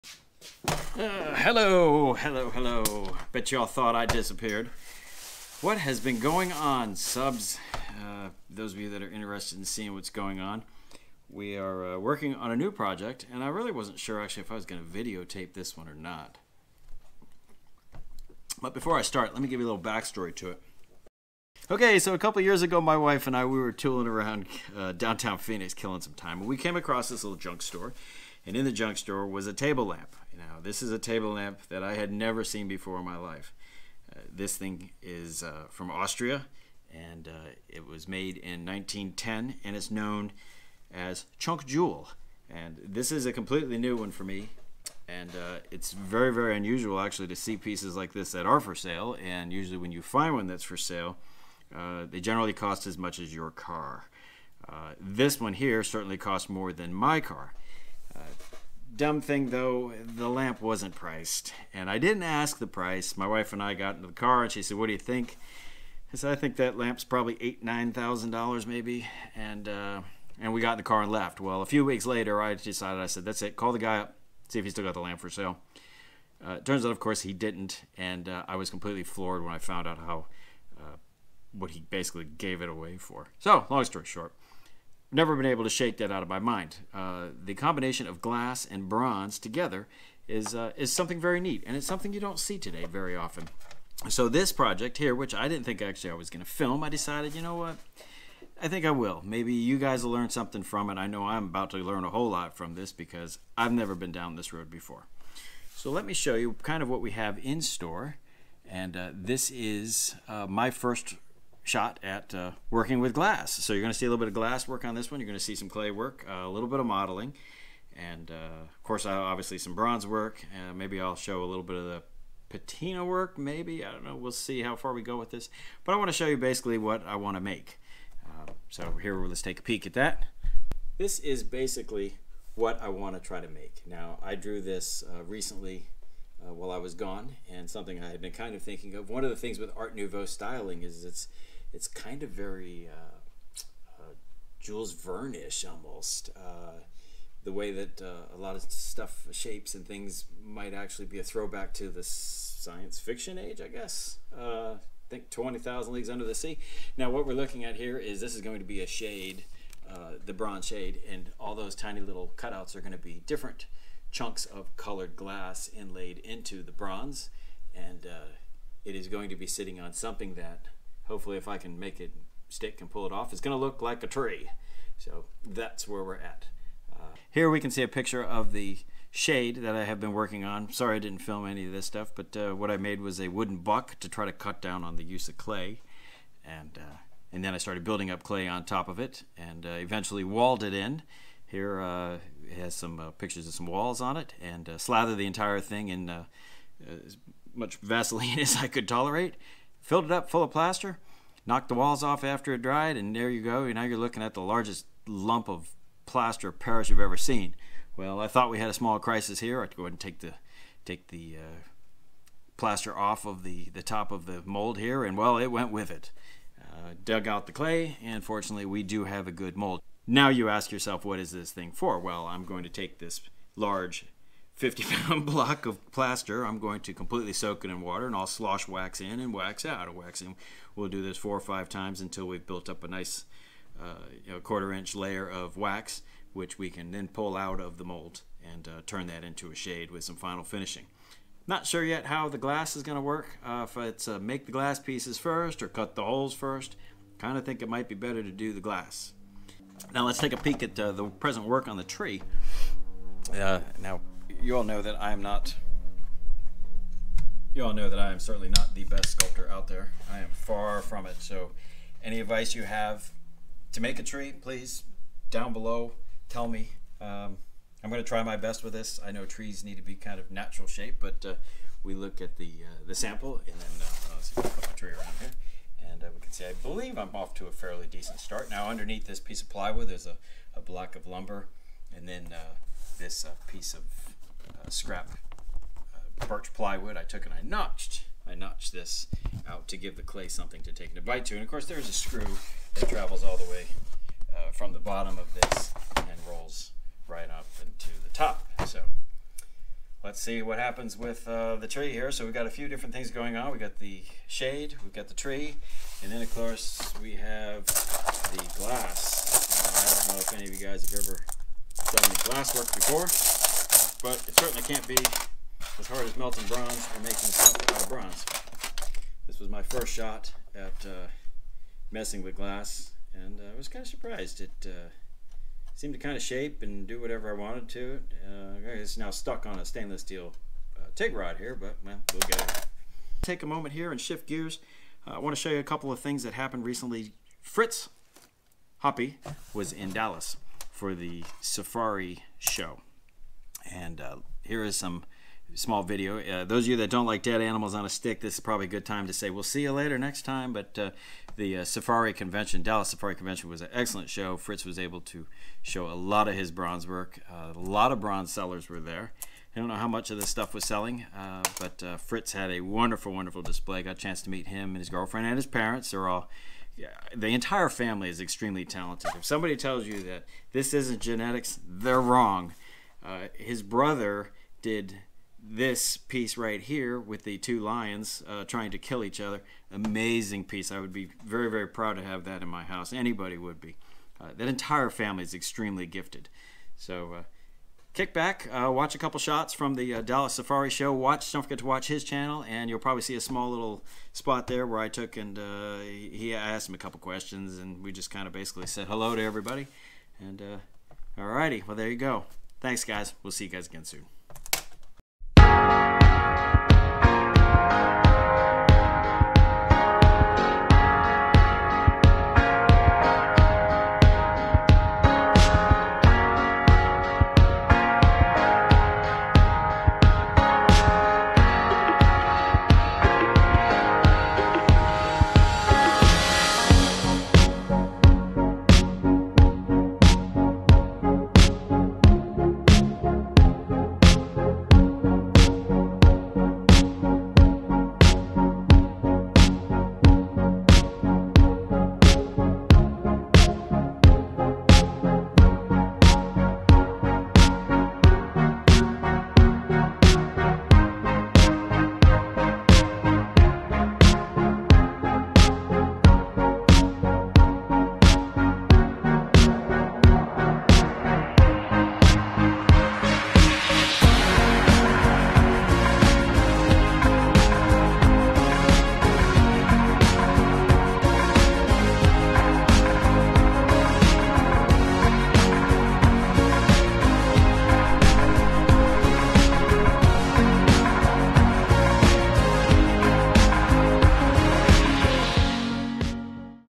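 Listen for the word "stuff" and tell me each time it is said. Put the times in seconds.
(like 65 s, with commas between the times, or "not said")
148 s, 181 s, 360 s.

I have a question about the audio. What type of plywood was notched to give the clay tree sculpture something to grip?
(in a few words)
Birch.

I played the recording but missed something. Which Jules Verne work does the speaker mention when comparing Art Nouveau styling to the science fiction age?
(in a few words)
20,000 Leagues Under the Sea.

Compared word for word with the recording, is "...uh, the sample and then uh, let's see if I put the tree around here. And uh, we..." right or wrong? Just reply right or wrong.
right.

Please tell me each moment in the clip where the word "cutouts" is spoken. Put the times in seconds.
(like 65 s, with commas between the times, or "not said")
162 s.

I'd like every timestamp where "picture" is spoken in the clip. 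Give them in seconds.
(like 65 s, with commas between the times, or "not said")
177 s, 193 s.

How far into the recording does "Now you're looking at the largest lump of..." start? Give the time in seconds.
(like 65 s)
203 s.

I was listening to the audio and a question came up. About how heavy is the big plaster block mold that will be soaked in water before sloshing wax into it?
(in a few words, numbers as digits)
50 pounds.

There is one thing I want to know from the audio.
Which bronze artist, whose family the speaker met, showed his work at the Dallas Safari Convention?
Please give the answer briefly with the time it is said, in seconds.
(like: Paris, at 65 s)
Fritz Hoppe, at 337 s.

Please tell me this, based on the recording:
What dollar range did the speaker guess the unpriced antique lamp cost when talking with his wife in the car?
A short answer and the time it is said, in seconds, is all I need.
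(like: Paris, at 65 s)
8,000 to 9,000 dollars, at 67 s.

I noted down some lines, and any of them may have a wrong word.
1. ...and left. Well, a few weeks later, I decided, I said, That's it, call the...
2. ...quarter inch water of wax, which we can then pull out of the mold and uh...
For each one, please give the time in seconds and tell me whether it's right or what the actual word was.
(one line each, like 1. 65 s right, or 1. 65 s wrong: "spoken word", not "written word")
1. 71 s right
2. 234 s wrong: "layer", not "water".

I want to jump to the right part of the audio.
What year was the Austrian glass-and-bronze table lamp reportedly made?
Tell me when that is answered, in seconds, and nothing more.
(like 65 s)
38 s.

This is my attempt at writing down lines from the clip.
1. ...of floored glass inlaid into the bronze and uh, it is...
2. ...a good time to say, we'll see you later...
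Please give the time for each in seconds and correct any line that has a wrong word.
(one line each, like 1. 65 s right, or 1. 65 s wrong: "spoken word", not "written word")
1. 164 s wrong: "colored", not "floored"
2. 348 s right.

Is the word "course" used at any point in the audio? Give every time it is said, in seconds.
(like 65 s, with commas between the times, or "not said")
76 s, 118 s, 291 s, 306 s.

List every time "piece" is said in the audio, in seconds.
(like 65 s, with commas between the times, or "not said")
47 s, 244 s, 279 s, 283 s, 375 s, 380 s.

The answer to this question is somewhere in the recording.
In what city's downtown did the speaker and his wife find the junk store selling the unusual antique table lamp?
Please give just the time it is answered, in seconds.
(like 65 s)
25 s.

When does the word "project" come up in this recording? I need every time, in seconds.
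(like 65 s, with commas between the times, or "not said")
12 s, 94 s.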